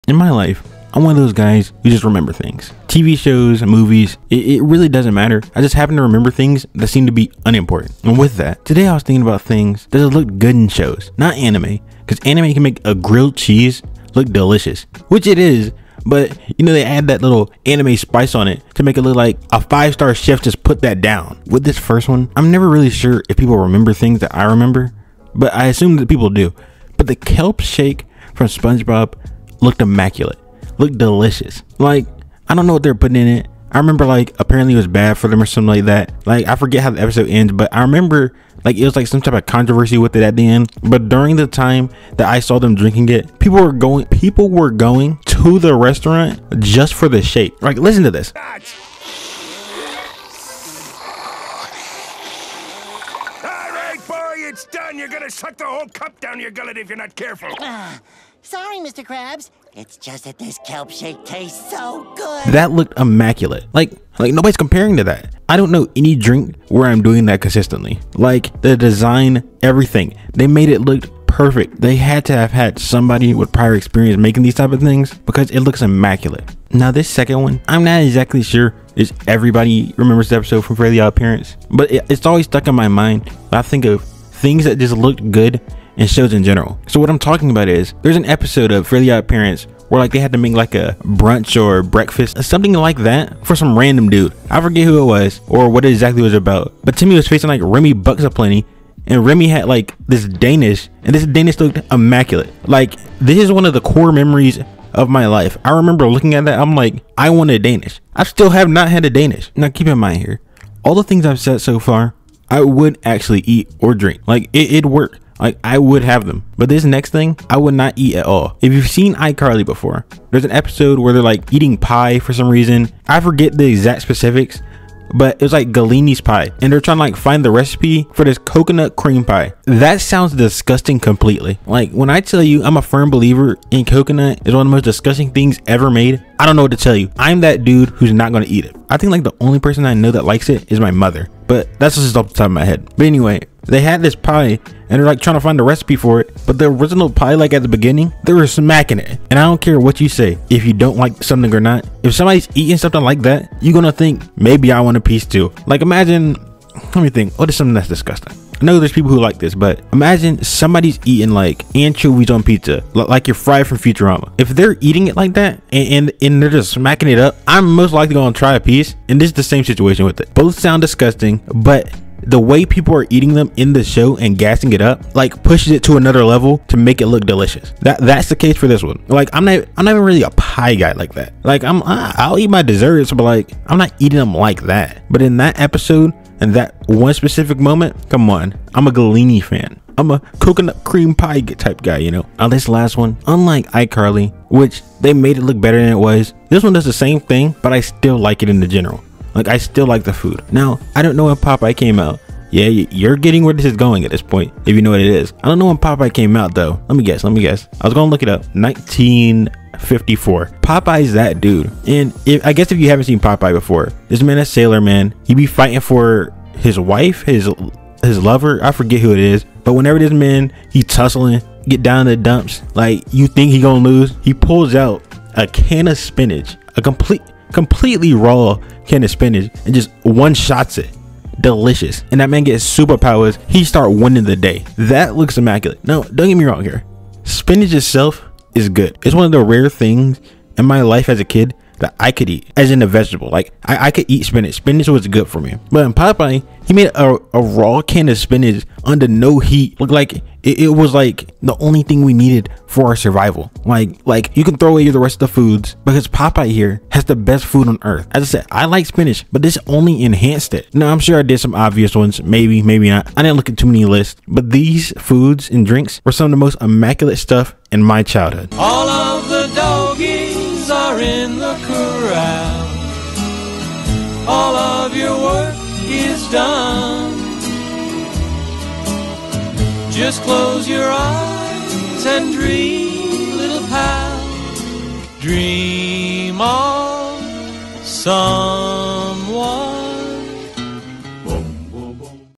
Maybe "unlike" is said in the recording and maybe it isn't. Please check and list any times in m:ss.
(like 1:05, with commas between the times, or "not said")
3:13.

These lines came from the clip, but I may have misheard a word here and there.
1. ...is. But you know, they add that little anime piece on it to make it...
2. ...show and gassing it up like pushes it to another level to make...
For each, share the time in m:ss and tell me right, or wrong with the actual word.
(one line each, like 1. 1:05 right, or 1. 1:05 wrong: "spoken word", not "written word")
1. 0:15 wrong: "spice", not "piece"
2. 2:53 right.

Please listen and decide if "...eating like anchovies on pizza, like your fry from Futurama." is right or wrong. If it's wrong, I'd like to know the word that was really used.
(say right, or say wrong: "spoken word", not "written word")
right.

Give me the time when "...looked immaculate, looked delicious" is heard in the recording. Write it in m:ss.
0:29.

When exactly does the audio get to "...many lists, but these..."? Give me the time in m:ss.
4:23.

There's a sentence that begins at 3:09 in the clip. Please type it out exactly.
I'm a coconut cream pie type guy, you know.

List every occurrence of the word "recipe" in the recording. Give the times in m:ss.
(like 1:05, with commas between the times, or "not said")
2:07, 2:25.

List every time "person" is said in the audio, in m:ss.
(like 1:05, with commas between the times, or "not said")
2:19.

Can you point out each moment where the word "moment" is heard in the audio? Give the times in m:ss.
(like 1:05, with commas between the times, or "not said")
3:07.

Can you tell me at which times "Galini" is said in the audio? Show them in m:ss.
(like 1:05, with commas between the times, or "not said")
2:05, 3:08.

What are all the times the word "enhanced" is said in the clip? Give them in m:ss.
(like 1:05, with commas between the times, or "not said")
4:20.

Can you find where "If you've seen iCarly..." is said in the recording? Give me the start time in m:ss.
1:58.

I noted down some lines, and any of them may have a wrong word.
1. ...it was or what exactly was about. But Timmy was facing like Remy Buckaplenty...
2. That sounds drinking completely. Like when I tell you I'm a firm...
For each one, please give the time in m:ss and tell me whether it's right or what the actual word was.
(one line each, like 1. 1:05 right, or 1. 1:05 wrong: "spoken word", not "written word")
1. 1:35 right
2. 2:09 wrong: "disgusting", not "drinking".